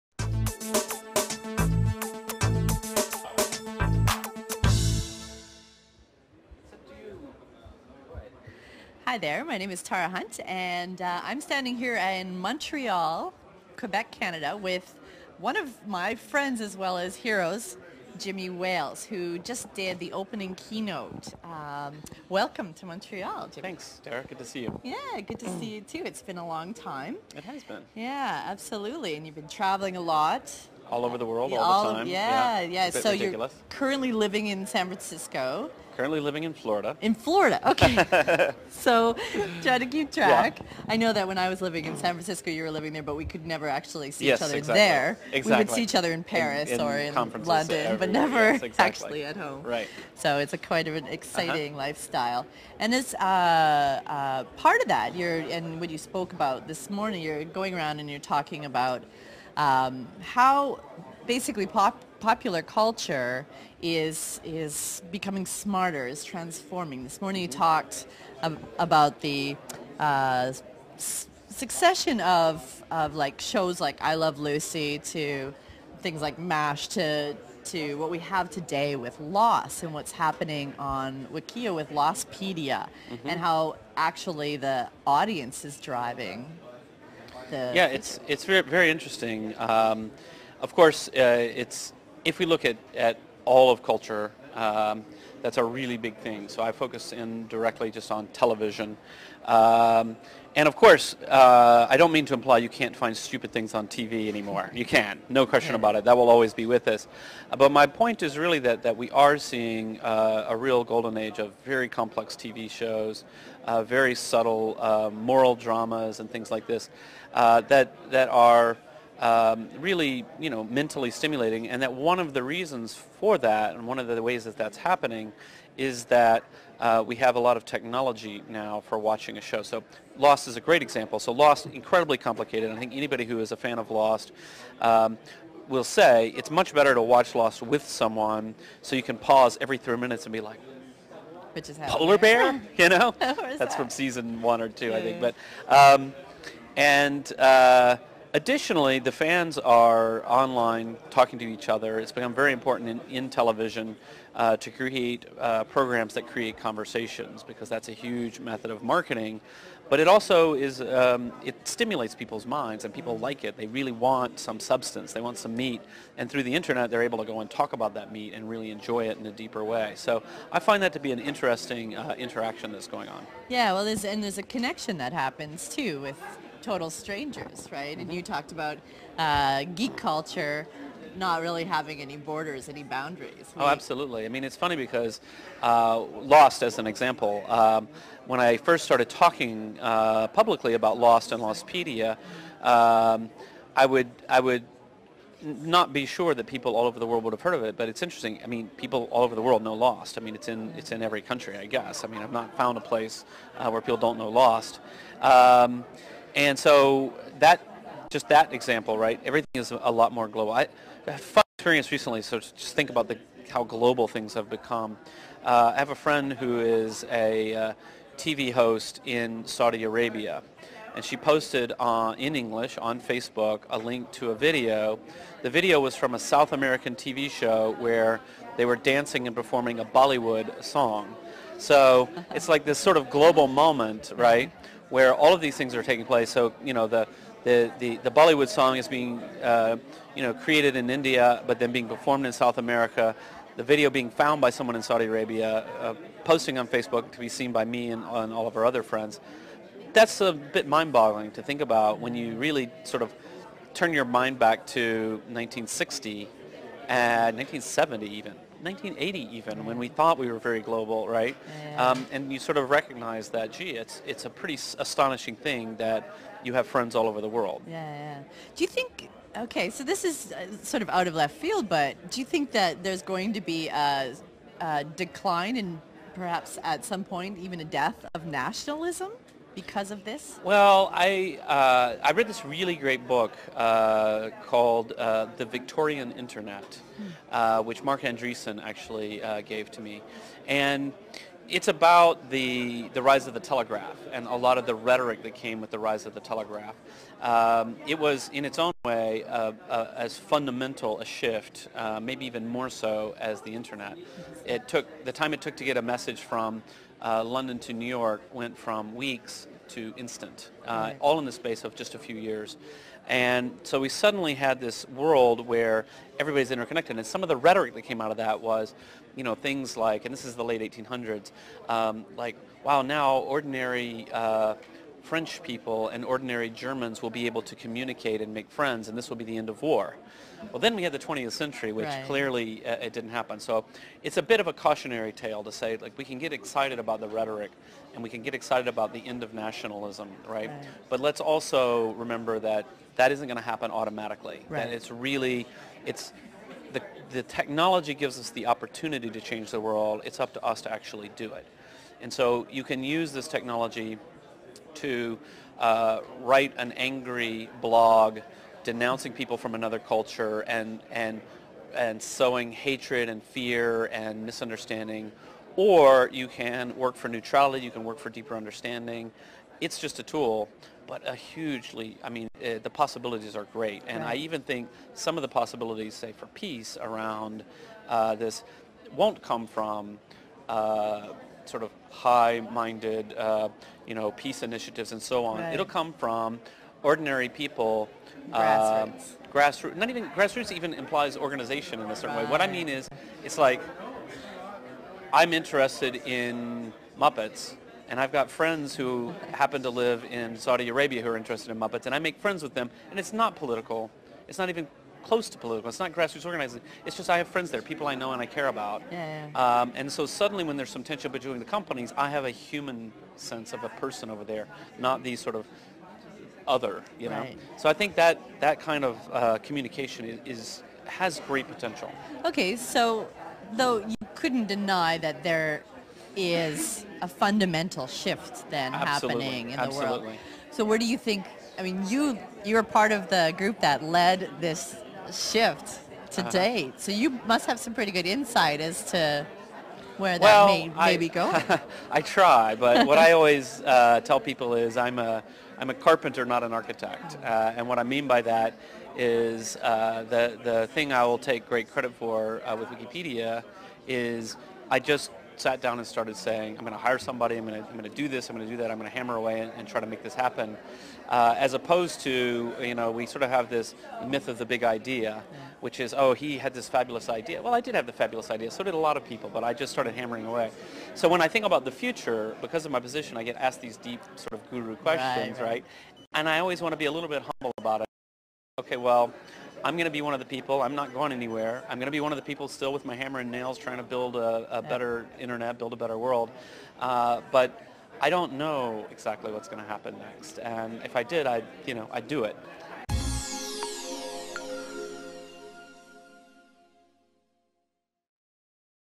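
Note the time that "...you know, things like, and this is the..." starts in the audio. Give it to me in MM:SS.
05:19.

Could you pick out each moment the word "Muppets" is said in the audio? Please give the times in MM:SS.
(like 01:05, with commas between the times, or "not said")
06:36, 06:41.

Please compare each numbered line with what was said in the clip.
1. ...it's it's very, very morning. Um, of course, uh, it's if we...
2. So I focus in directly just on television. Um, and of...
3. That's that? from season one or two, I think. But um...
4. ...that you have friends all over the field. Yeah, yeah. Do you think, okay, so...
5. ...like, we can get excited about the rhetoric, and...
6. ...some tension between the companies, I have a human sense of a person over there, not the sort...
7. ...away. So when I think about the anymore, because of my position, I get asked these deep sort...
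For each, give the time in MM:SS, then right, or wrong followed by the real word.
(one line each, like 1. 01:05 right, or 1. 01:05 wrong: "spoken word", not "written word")
1. 01:27 wrong: "interesting", not "morning"
2. 01:36 right
3. 02:23 right
4. 04:25 wrong: "world", not "field"
5. 05:35 right
6. 06:50 right
7. 07:50 wrong: "future", not "anymore".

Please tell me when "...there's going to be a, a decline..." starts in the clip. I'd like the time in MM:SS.
04:32.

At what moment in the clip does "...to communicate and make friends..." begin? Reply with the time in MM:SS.
05:27.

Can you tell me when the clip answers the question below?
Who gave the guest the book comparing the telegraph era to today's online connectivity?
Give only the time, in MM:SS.
04:47.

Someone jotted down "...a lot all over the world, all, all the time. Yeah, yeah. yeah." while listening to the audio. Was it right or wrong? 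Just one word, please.
right.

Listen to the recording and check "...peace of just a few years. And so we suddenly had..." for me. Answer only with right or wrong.
wrong.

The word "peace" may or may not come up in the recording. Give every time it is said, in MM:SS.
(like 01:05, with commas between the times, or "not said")
06:16, 06:24.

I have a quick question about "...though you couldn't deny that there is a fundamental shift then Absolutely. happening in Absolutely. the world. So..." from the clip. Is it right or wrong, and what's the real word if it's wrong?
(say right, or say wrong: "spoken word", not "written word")
right.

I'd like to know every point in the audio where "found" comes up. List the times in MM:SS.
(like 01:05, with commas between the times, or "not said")
03:22, 04:04.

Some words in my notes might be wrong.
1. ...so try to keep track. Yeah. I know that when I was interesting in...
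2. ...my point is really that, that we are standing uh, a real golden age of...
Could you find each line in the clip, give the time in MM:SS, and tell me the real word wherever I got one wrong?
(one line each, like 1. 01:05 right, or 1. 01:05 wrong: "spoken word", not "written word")
1. 00:38 wrong: "living", not "interesting"
2. 01:47 wrong: "seeing", not "standing".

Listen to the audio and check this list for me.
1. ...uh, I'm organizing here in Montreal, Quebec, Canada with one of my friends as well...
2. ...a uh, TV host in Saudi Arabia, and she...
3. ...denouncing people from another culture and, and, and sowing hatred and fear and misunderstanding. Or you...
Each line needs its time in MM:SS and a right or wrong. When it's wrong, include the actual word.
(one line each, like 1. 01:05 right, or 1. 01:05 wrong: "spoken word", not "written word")
1. 00:11 wrong: "standing", not "organizing"
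2. 03:37 right
3. 05:58 right.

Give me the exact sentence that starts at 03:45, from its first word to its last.
The video was from a South American TV show where they were dancing and performing a Bollywood song.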